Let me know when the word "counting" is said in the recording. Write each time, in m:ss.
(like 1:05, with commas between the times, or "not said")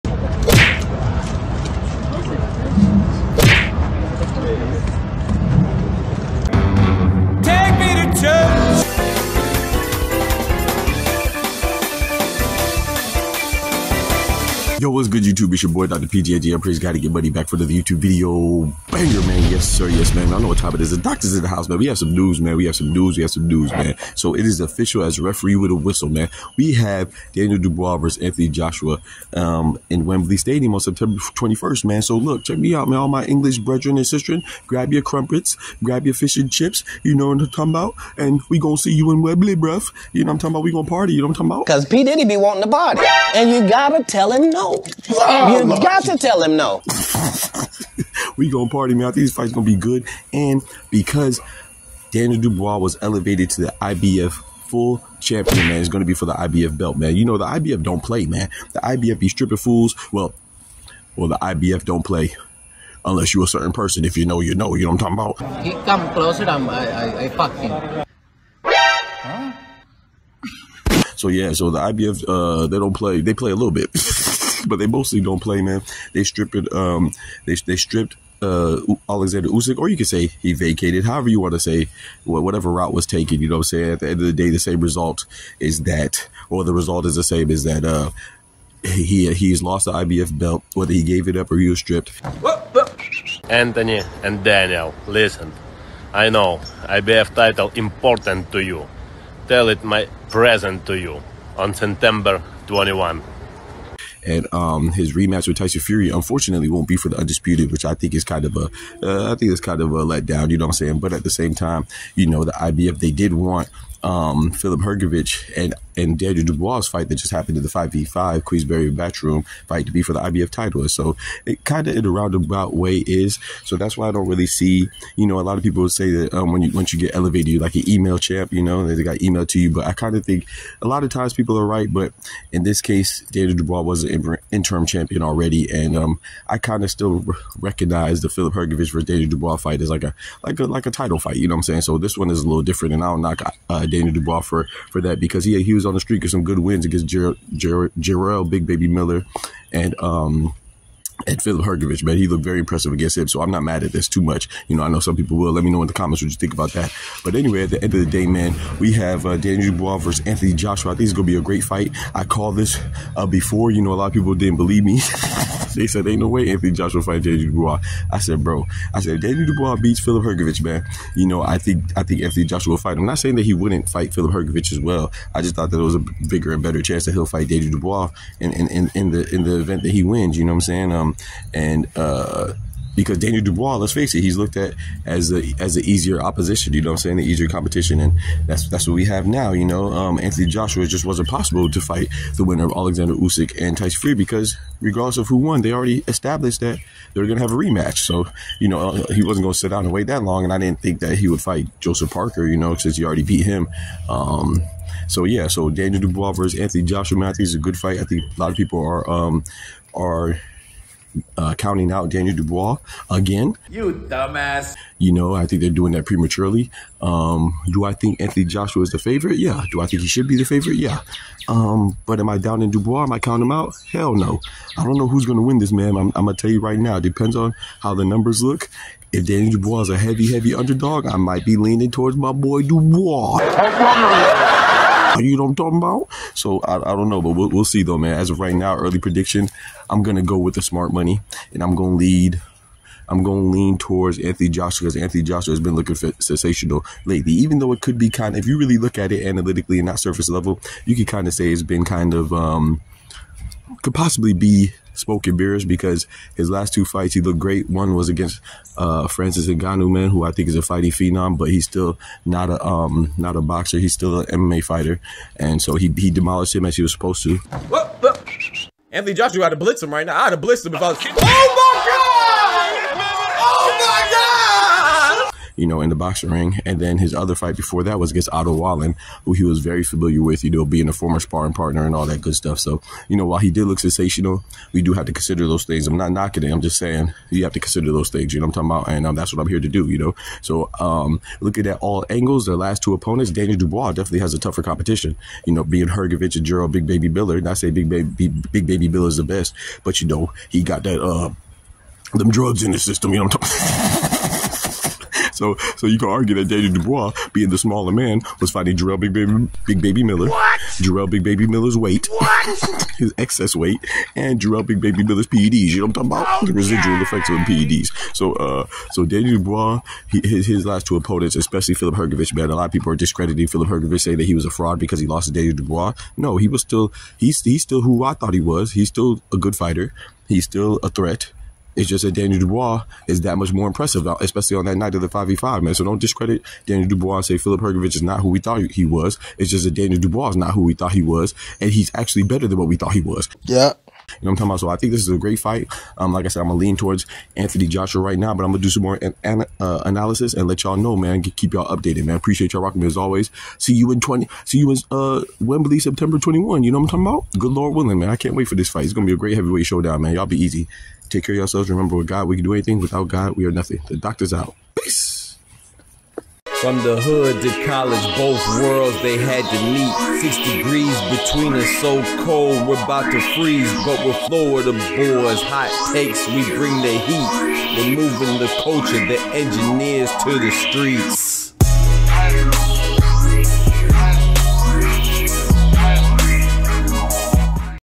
3:31, 3:43.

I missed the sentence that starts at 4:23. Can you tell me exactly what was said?
He's still an MMA fighter, and so he he demolished him as he was supposed to.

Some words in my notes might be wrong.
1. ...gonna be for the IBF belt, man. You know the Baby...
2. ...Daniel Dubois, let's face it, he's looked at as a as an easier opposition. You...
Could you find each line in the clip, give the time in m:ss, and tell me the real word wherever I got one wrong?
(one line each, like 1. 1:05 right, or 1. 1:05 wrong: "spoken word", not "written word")
1. 0:55 wrong: "IBF", not "Baby"
2. 3:03 right.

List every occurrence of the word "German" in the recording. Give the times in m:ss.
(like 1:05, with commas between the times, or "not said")
not said.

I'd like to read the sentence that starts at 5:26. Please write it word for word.
No, he was still he's he's still who I thought he was.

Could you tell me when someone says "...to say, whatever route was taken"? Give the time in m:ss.
1:21.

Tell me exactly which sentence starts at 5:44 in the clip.
So I think this is a great fight.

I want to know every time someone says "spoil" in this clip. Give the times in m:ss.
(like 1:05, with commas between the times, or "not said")
not said.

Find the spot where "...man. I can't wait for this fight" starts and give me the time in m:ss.
5:57.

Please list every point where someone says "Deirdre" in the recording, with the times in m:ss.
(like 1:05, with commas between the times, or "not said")
1:56, 2:13, 2:19.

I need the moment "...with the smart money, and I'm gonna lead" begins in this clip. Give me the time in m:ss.
4:00.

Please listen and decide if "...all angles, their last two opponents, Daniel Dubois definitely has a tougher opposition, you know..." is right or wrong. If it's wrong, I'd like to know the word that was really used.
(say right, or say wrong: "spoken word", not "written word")
wrong: "competition", not "opposition".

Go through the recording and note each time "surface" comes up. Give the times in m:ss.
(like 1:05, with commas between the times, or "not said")
4:09.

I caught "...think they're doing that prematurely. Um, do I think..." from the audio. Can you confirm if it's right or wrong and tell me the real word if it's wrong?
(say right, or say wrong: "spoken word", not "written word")
right.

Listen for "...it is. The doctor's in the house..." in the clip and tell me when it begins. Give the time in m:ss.
0:20.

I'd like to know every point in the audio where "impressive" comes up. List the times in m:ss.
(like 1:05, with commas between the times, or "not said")
2:32, 5:33.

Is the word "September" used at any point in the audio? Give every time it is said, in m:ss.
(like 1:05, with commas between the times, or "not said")
0:30, 1:41, 5:55.